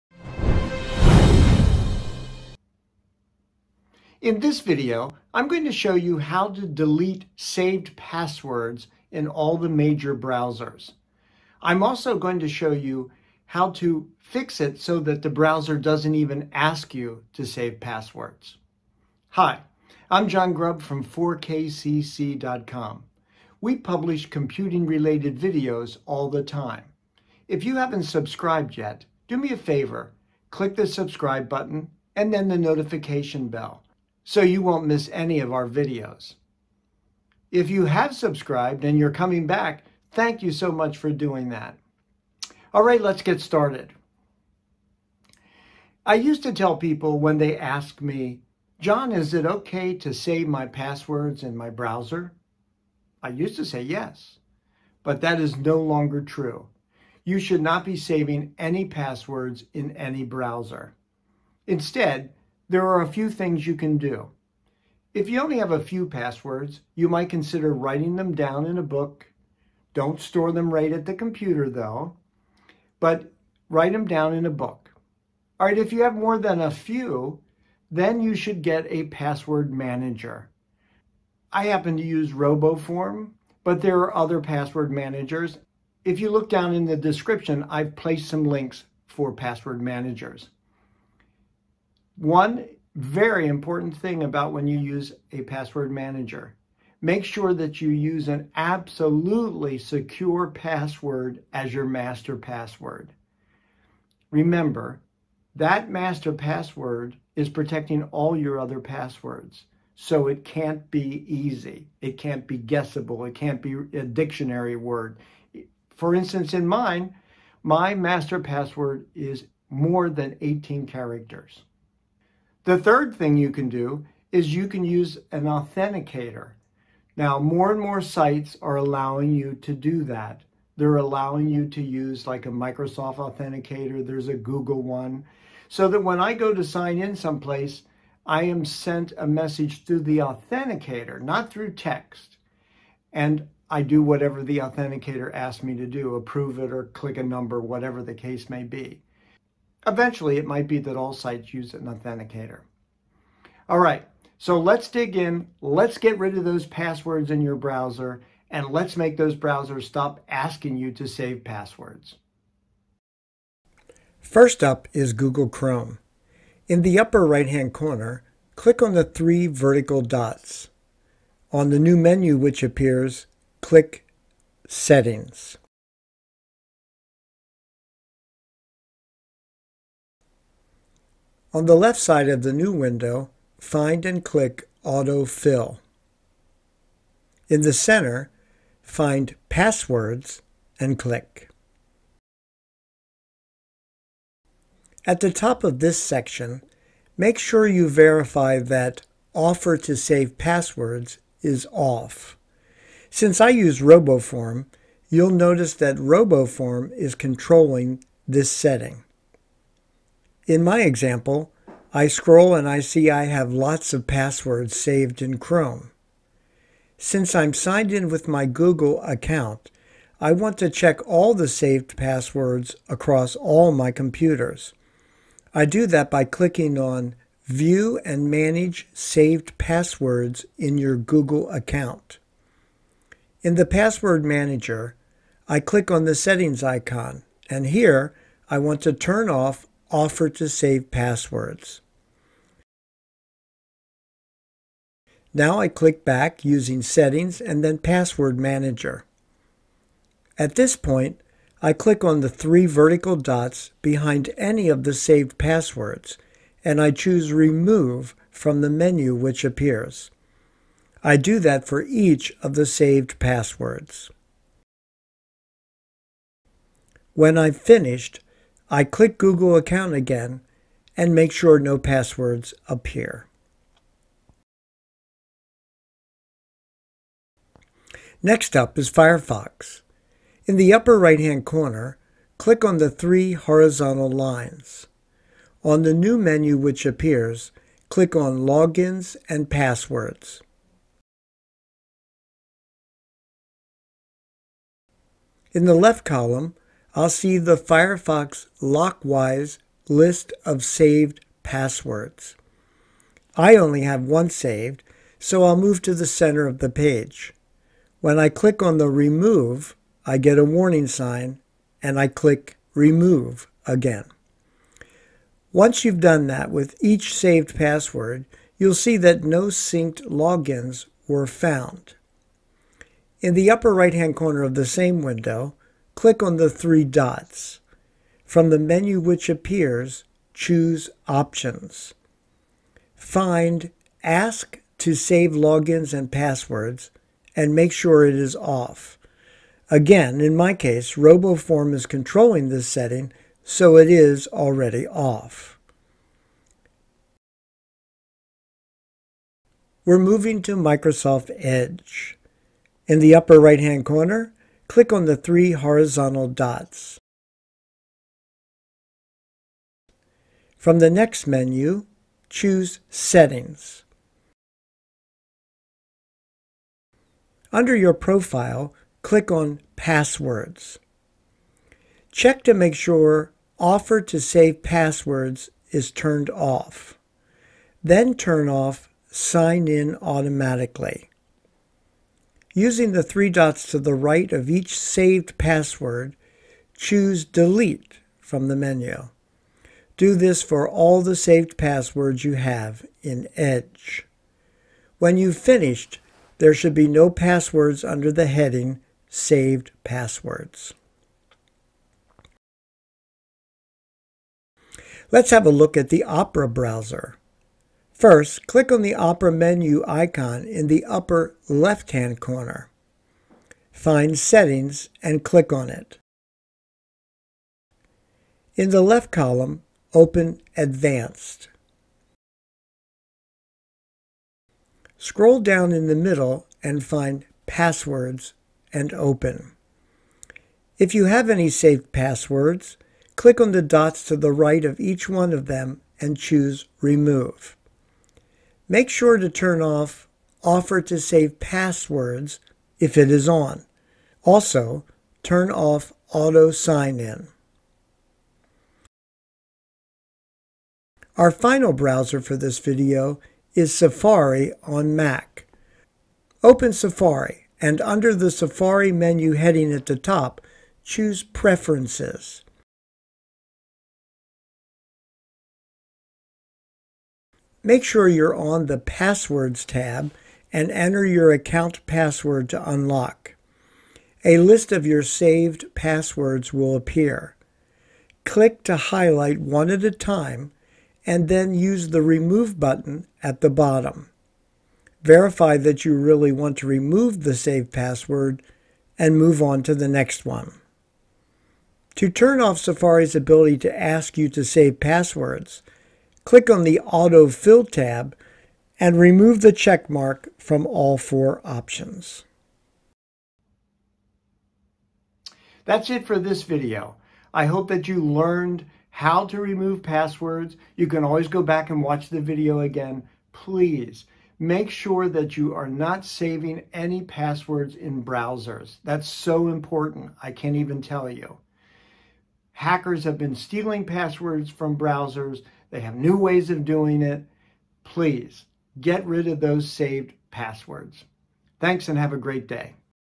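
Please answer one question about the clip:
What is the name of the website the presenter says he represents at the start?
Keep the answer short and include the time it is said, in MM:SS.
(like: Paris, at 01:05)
4kcc.com, at 00:21.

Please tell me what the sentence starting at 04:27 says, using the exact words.
When I've finished, I click Google account again and make sure no passwords appear.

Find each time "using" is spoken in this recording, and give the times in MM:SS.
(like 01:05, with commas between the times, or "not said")
04:06, 06:22.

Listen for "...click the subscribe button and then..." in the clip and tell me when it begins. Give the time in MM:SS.
00:30.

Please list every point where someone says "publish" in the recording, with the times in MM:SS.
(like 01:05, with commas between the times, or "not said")
00:23.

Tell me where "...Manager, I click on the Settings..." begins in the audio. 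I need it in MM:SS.
03:54.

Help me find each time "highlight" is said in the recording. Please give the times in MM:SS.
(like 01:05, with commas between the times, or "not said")
07:58.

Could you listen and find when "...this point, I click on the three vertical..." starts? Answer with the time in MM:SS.
04:10.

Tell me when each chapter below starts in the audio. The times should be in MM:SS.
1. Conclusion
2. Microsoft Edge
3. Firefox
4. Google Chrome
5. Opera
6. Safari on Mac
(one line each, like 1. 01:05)
1. 08:22
2. 05:47
3. 04:38
4. 02:43
5. 06:44
6. 07:27.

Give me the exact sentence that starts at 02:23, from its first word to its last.
And I do whatever the authenticator asks me to do, approve it or click a number, whatever the case may be.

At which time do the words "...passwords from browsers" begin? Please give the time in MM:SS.
08:43.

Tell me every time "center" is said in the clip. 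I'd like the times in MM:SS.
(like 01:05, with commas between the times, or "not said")
03:07, 05:06.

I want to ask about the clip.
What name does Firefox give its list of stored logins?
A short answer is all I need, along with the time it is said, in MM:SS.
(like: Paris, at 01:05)
Firefox Lockwise, at 04:57.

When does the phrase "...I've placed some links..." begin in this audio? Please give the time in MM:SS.
01:27.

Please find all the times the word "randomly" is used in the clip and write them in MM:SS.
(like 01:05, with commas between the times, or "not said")
not said.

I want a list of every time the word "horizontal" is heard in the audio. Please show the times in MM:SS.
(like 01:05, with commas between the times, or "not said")
04:43, 05:55.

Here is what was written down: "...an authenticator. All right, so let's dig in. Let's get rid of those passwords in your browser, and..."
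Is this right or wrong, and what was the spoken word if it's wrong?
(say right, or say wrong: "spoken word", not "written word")
right.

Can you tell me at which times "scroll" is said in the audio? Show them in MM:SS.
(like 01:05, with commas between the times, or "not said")
03:32, 07:04.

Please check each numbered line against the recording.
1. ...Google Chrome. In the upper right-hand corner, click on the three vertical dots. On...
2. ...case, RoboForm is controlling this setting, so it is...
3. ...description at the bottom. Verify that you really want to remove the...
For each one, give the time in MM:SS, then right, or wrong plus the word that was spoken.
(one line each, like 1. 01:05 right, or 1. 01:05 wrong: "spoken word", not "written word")
1. 02:45 right
2. 05:40 right
3. 08:02 wrong: "button", not "description".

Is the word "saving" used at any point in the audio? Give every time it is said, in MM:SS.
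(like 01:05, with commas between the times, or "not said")
00:57, 08:36.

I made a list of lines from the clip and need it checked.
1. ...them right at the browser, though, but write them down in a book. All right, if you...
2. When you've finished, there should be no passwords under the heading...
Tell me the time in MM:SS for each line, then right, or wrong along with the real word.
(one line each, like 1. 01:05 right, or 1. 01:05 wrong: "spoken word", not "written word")
1. 01:10 wrong: "computer", not "browser"
2. 06:34 right.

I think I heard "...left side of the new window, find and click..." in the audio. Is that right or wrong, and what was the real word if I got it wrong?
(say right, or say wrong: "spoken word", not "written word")
right.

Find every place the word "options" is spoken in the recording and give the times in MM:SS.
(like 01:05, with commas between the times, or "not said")
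05:31, 08:21.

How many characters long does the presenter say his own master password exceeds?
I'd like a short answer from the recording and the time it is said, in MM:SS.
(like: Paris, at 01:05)
18, at 02:00.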